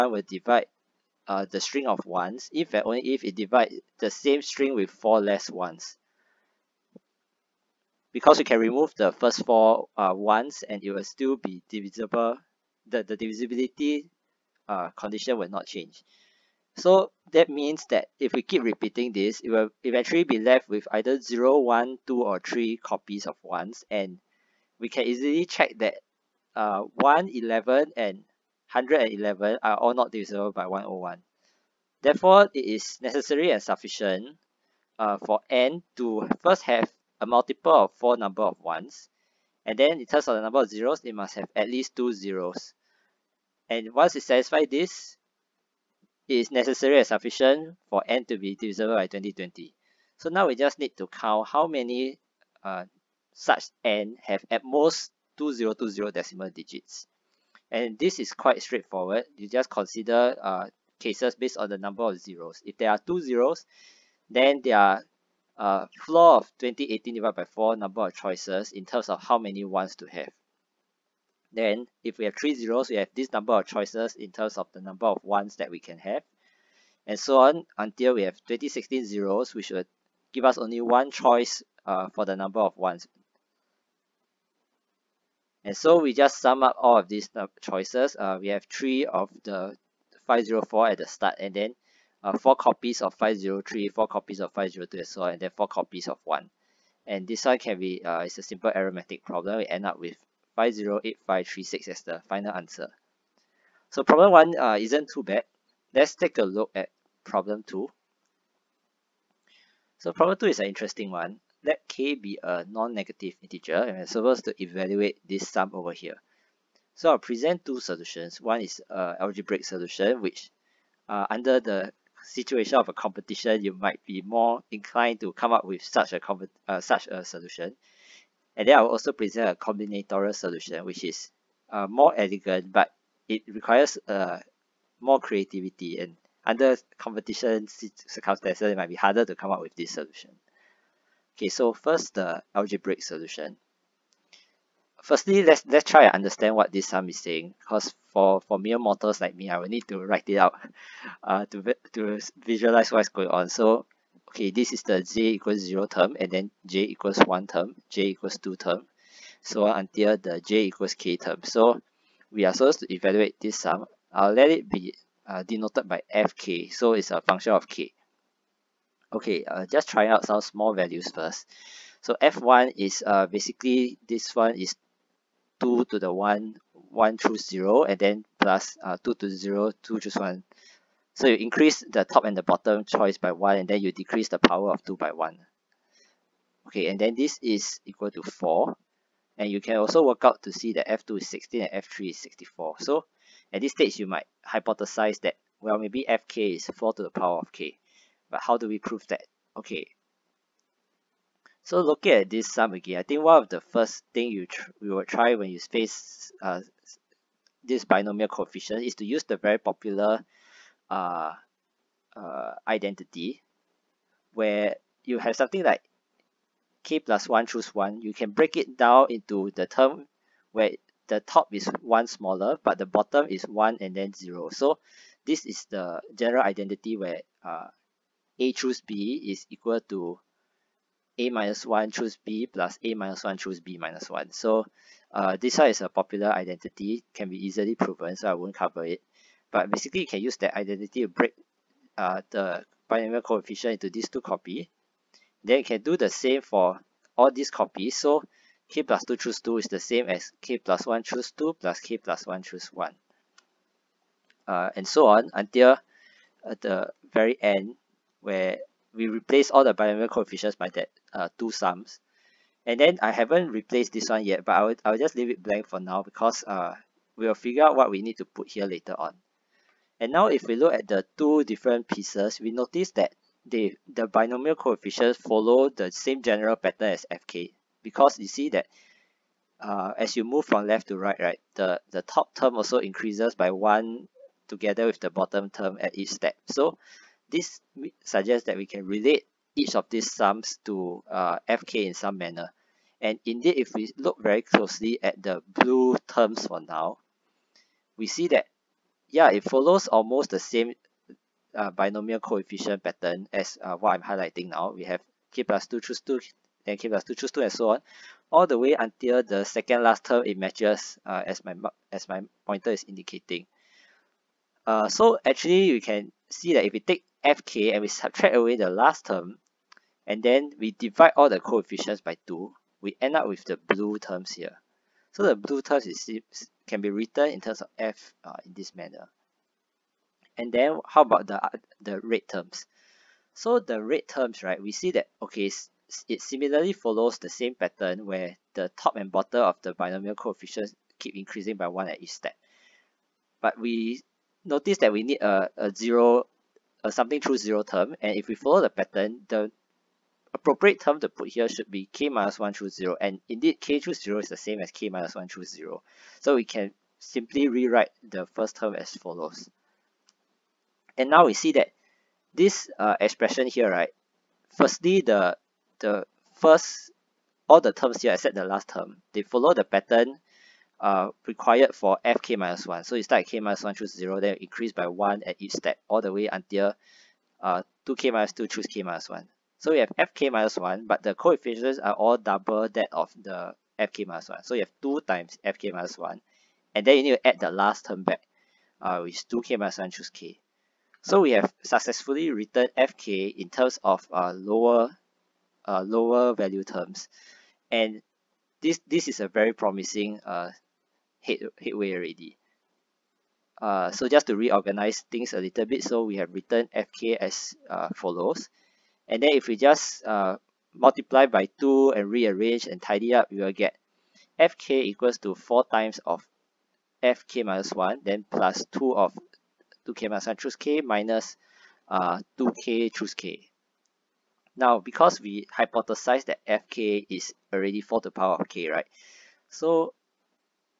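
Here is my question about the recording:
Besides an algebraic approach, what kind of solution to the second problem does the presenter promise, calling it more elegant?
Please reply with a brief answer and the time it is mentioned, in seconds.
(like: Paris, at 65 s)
combinatorial solution, at 129 s.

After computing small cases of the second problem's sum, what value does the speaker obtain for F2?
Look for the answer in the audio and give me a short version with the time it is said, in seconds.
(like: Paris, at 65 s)
16, at 191 s.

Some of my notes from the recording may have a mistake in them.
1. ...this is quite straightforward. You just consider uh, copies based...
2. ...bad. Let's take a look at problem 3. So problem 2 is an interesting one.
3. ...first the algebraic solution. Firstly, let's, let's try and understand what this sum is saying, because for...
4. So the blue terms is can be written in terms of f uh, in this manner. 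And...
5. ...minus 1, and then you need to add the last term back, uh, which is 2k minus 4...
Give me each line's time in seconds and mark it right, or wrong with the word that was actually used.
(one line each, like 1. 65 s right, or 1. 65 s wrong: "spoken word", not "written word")
1. 57 s wrong: "cases", not "copies"
2. 105 s wrong: "2", not "3"
3. 141 s right
4. 325 s right
5. 385 s wrong: "1", not "4".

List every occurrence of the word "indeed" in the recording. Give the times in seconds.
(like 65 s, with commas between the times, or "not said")
293 s, 353 s.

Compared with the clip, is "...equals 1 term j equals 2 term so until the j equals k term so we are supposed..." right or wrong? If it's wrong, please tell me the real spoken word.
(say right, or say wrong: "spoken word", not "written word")
right.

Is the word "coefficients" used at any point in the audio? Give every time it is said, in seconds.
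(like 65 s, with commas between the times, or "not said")
208 s, 243 s, 260 s, 274 s, 302 s, 321 s, 340 s, 381 s.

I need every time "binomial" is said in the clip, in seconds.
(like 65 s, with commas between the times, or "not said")
207 s, 242 s, 259 s, 274 s, 301 s, 339 s.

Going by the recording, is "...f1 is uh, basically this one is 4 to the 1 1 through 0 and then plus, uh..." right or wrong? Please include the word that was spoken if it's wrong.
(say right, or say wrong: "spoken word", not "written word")
wrong: "2", not "4".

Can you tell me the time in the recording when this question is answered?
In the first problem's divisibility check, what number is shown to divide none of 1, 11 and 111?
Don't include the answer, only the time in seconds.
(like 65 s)
30 s.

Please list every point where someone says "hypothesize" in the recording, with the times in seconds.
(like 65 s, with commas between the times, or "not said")
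194 s, 425 s.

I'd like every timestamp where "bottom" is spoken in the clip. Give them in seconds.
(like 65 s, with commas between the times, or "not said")
182 s, 222 s, 285 s, 339 s.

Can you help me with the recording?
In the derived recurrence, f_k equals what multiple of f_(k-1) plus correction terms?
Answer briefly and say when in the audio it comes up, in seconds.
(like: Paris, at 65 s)
4 times, at 415 s.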